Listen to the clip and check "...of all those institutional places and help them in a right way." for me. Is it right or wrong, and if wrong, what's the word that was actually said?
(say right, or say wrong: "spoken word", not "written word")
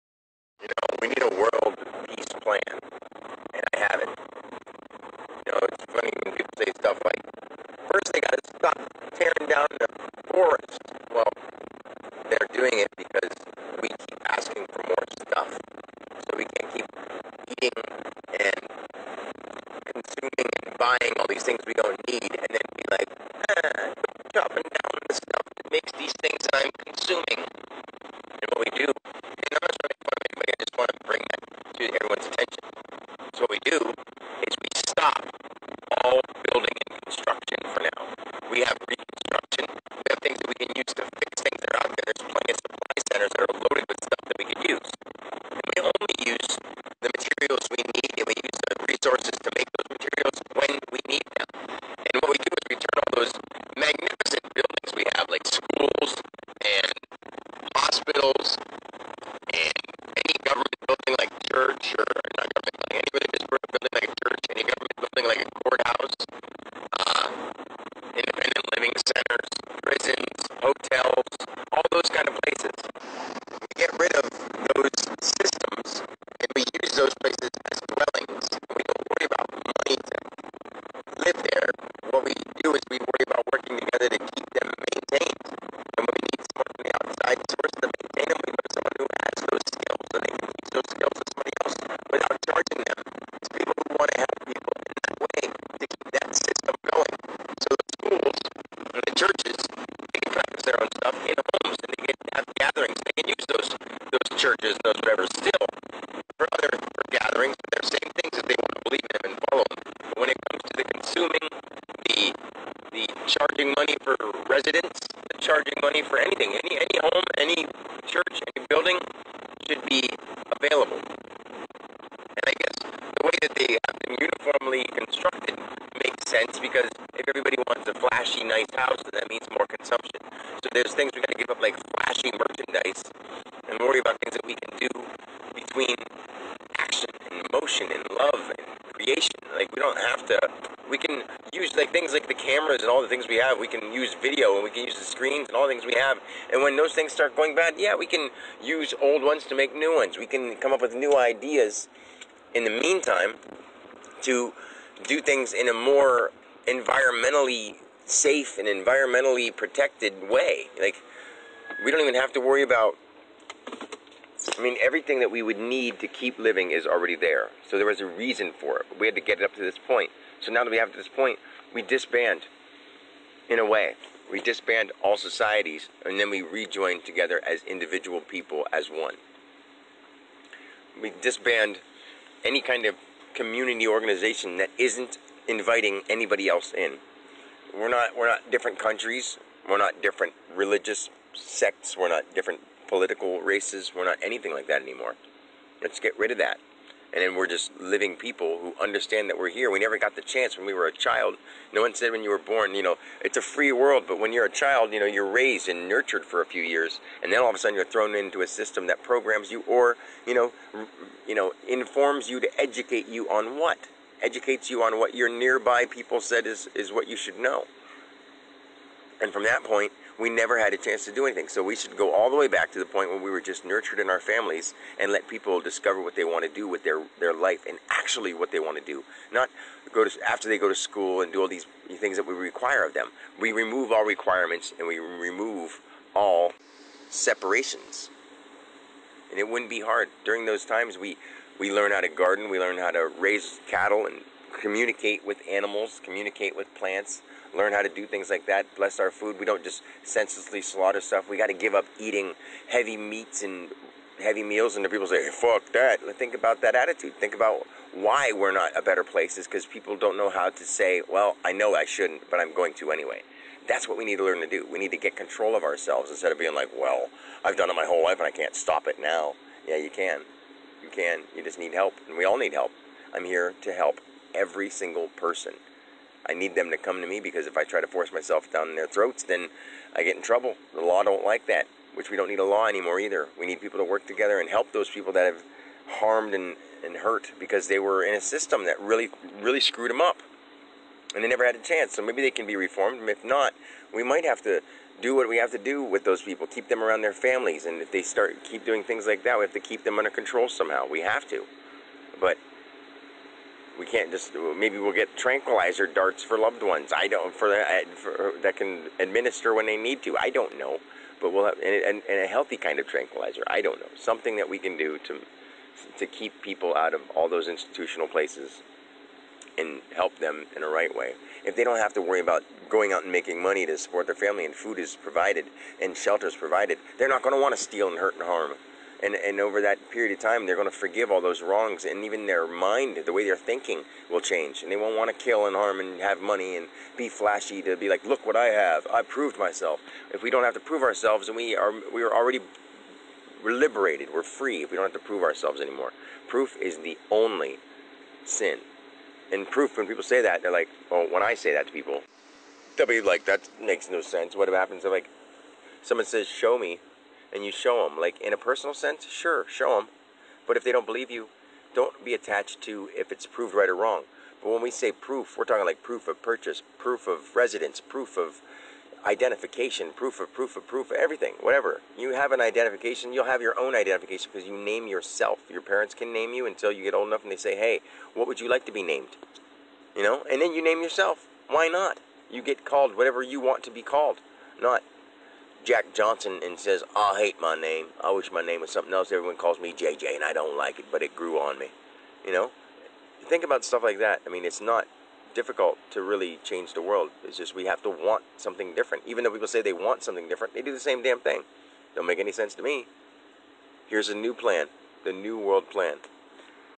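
right.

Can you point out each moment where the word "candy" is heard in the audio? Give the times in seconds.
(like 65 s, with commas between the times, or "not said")
not said.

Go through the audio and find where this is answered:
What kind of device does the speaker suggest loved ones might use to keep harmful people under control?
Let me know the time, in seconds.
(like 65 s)
305 s.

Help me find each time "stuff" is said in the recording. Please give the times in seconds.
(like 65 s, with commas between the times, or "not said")
6 s, 251 s, 393 s.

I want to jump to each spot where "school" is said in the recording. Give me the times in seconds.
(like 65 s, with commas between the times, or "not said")
230 s.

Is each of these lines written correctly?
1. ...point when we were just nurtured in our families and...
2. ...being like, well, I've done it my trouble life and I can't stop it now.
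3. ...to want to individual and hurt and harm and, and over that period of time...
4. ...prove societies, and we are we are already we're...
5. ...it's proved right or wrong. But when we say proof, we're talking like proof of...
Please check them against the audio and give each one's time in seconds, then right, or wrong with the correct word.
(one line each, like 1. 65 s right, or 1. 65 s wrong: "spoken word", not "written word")
1. 222 s right
2. 266 s wrong: "whole", not "trouble"
3. 327 s wrong: "steal", not "individual"
4. 340 s wrong: "ourselves", not "societies"
5. 363 s right.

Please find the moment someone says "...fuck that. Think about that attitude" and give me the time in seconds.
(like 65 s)
255 s.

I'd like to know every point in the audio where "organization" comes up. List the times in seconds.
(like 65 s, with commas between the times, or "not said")
183 s.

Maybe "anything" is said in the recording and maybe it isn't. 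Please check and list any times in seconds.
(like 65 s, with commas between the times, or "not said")
116 s, 194 s, 221 s.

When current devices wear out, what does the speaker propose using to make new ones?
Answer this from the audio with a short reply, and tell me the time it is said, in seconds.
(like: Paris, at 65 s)
old ones, at 149 s.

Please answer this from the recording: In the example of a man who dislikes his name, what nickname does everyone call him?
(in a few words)
JJ.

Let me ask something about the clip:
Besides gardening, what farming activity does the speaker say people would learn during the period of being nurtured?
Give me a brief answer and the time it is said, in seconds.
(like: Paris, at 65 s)
raise cattle, at 243 s.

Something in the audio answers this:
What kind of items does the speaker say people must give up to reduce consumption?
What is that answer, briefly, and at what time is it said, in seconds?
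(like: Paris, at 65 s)
flashy merchandise, at 131 s.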